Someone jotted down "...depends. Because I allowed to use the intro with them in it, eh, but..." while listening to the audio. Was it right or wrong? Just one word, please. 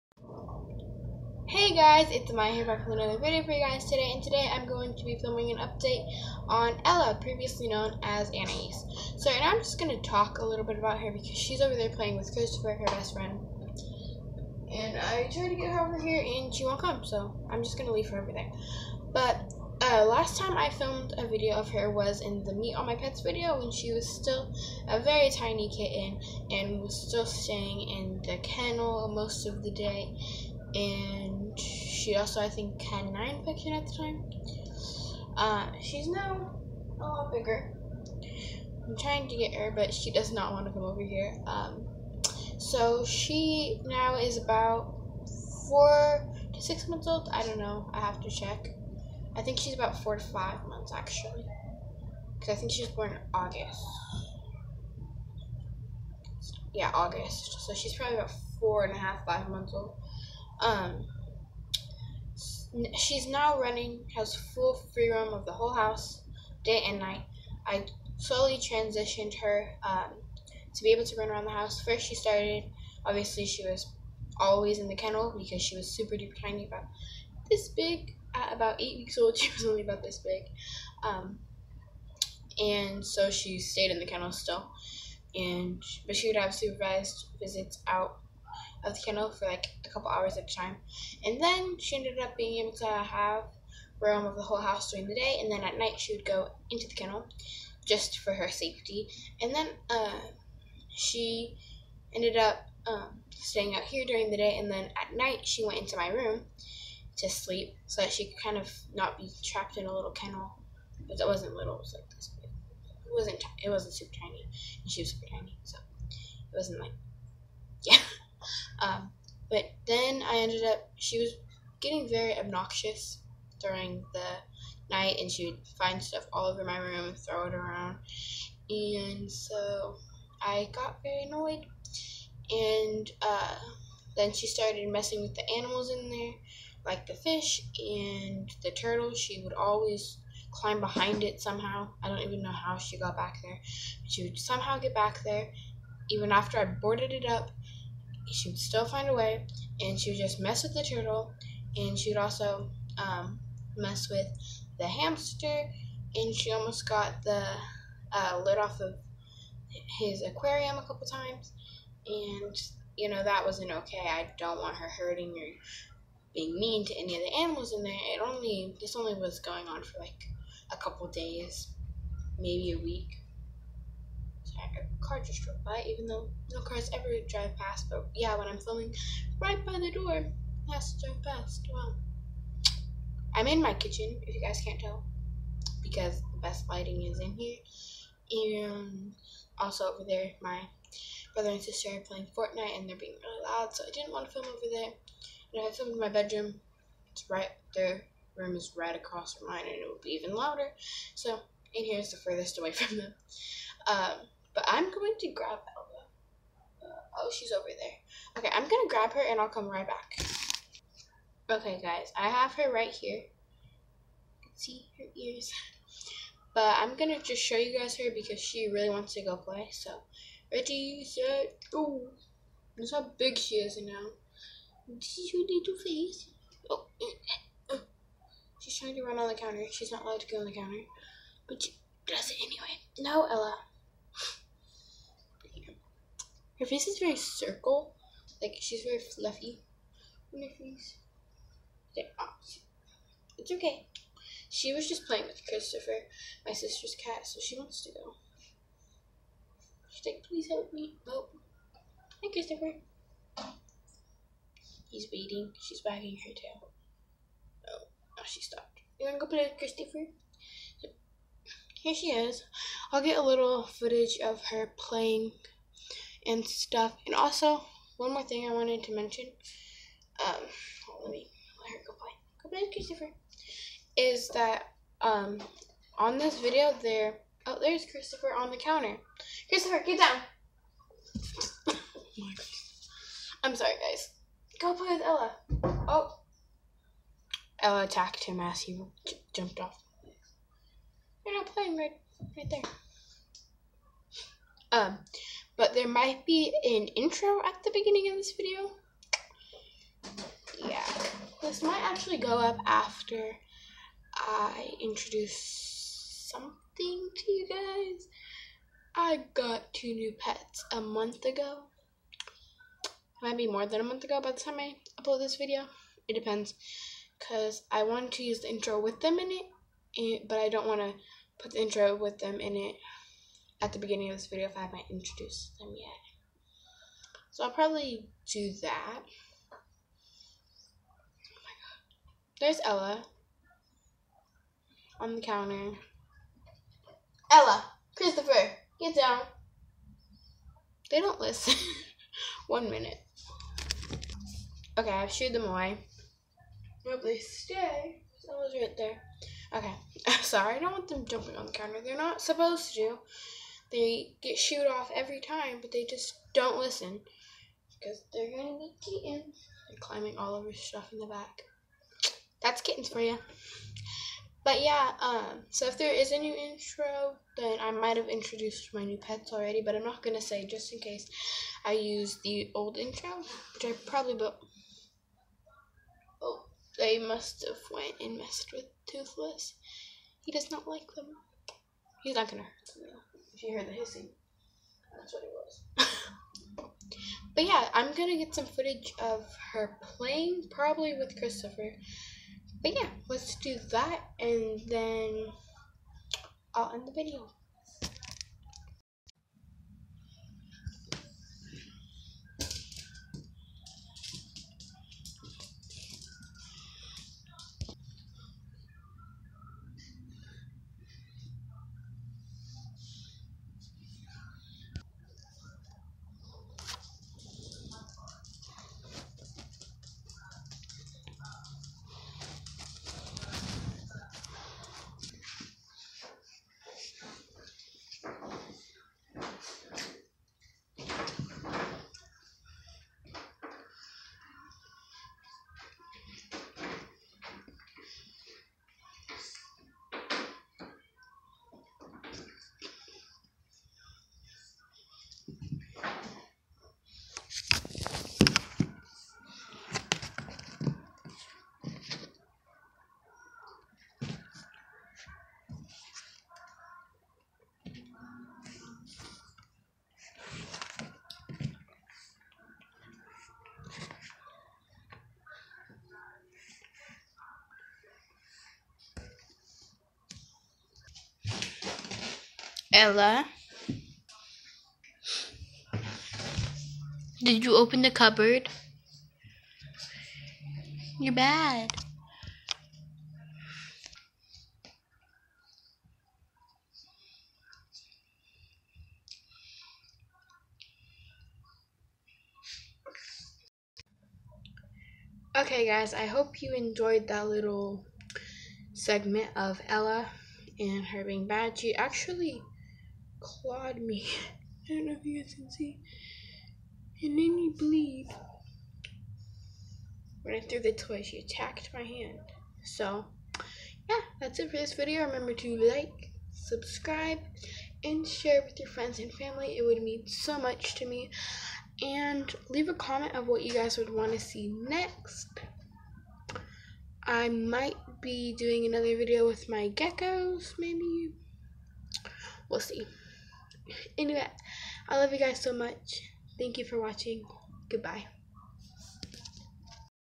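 wrong.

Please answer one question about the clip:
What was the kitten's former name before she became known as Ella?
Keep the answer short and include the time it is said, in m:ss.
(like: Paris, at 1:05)
Anais, at 0:08.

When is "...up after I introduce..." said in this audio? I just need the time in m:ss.
5:02.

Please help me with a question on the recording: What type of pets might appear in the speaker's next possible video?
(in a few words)
Geckos.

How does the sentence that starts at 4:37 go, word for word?
Oh, there's Christopher on the counter.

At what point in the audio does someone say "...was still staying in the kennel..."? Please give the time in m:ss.
0:26.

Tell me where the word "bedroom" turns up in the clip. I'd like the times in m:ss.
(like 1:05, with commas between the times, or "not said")
3:16.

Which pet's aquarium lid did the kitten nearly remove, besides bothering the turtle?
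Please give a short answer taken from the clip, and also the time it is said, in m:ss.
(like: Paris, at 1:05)
Hamster, at 2:34.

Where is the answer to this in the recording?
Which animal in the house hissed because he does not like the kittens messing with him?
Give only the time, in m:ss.
6:18.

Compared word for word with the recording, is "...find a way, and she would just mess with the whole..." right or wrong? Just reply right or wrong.
wrong.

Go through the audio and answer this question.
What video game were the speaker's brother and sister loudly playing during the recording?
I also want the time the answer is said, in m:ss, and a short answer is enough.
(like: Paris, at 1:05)
Fortnite, at 3:12.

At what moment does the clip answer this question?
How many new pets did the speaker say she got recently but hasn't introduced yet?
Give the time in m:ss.
5:09.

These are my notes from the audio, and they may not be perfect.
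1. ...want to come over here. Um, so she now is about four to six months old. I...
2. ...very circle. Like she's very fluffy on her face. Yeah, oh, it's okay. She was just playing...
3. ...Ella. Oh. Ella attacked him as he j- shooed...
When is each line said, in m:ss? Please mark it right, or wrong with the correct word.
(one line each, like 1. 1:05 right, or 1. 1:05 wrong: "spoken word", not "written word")
1. 0:40 right
2. 3:56 right
3. 4:45 wrong: "jumped", not "shooed".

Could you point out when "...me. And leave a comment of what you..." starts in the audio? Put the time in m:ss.
8:40.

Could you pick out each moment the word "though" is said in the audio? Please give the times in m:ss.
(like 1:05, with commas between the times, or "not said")
2:56, 6:22.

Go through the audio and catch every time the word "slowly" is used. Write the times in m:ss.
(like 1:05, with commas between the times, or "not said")
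1:08.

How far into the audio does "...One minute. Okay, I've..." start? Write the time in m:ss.
5:42.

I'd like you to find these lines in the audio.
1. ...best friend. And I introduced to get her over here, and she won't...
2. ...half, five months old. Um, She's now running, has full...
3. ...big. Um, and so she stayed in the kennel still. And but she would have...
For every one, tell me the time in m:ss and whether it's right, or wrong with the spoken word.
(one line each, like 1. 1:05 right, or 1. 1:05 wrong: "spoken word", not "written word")
1. 0:12 wrong: "tried", not "introduced"
2. 0:58 right
3. 1:20 right.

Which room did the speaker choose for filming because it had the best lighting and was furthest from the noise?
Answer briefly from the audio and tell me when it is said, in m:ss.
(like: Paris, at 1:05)
Kitchen, at 3:03.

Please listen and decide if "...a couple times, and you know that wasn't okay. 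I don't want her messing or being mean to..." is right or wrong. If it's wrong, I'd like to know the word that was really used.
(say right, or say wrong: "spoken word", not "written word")
wrong: "hurting", not "messing".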